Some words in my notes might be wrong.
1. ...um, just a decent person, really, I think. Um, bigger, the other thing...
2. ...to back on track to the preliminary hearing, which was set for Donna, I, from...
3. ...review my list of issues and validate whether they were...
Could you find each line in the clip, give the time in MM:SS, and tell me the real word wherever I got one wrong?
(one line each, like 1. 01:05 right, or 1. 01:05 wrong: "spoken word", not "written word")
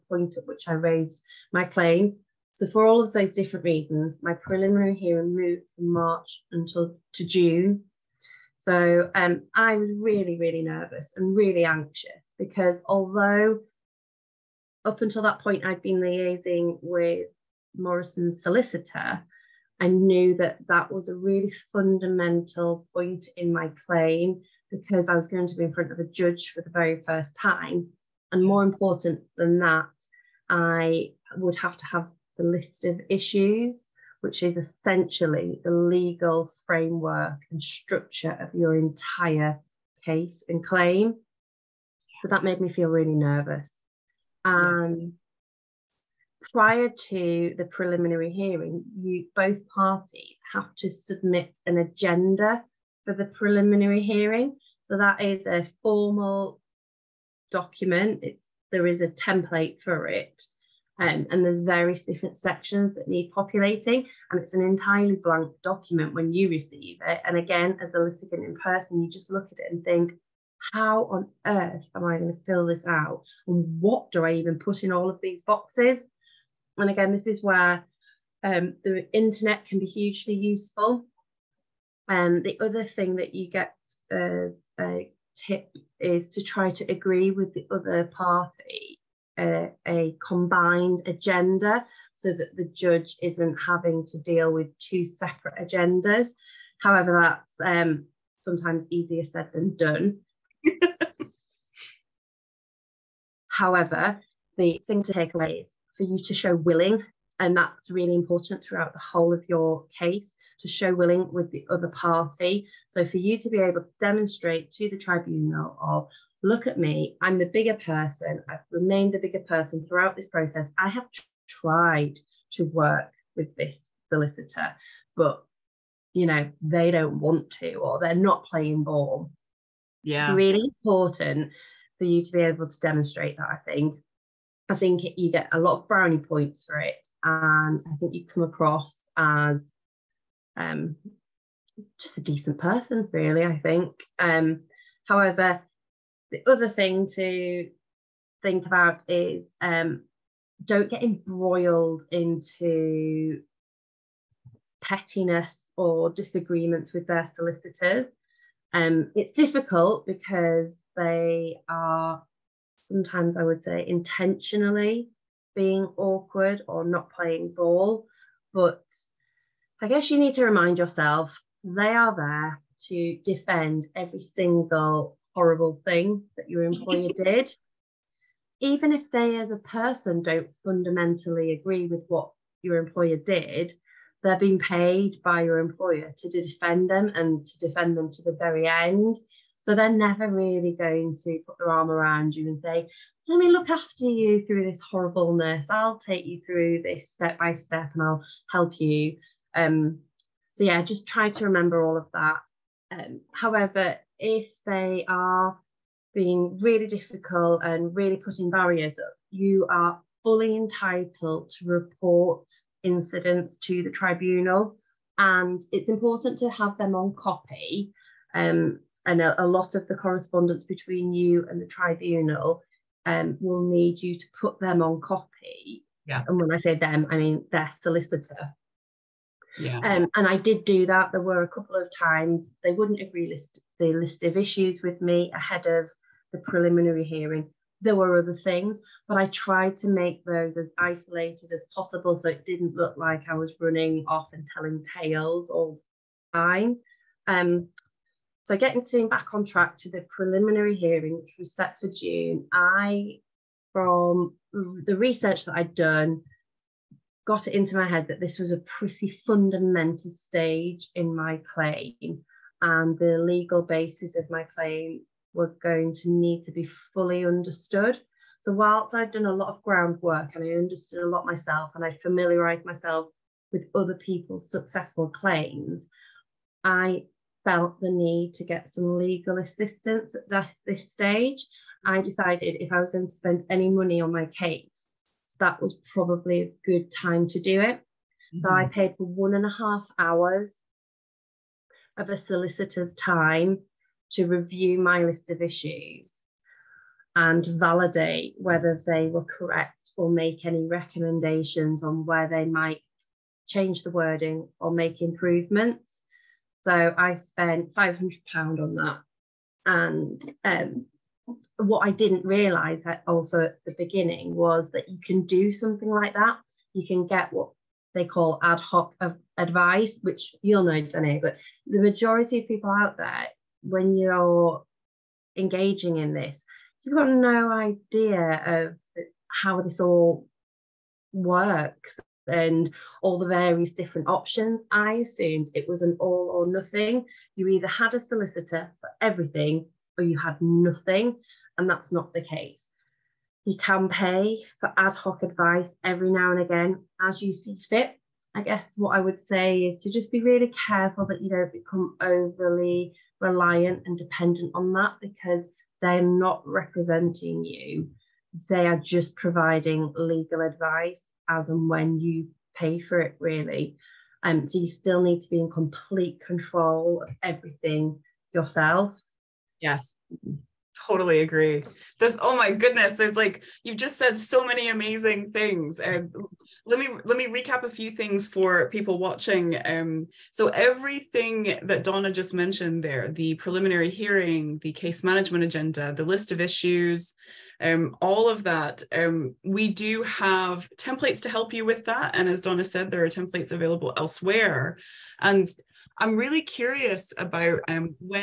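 1. 02:20 wrong: "however", not "bigger"
2. 04:08 wrong: "June", not "Donna"
3. 04:54 right.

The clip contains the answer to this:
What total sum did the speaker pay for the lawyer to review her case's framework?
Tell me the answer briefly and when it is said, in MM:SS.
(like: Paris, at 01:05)
£500, at 05:07.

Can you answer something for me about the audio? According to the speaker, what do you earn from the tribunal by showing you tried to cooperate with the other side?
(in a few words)
brownie points.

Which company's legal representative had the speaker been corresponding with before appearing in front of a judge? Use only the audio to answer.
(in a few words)
Morrison's.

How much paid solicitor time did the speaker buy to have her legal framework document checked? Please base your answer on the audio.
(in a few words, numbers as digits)
1.5 hours.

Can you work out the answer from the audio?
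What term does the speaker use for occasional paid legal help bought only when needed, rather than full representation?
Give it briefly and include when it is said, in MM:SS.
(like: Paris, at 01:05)
ad hoc advice, at 05:18.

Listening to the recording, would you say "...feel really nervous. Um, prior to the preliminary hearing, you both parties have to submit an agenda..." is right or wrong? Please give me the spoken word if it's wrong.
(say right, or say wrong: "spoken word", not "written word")
right.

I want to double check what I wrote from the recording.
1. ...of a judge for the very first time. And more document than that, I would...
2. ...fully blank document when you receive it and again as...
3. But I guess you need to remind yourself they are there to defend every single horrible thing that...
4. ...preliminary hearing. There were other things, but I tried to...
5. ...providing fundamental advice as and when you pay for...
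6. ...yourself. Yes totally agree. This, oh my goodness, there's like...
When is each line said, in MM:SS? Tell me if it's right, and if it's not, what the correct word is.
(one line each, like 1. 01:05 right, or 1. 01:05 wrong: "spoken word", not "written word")
1. 00:25 wrong: "important", not "document"
2. 01:04 wrong: "entirely", not "fully"
3. 02:48 right
4. 03:56 right
5. 05:59 wrong: "legal", not "fundamental"
6. 06:08 right.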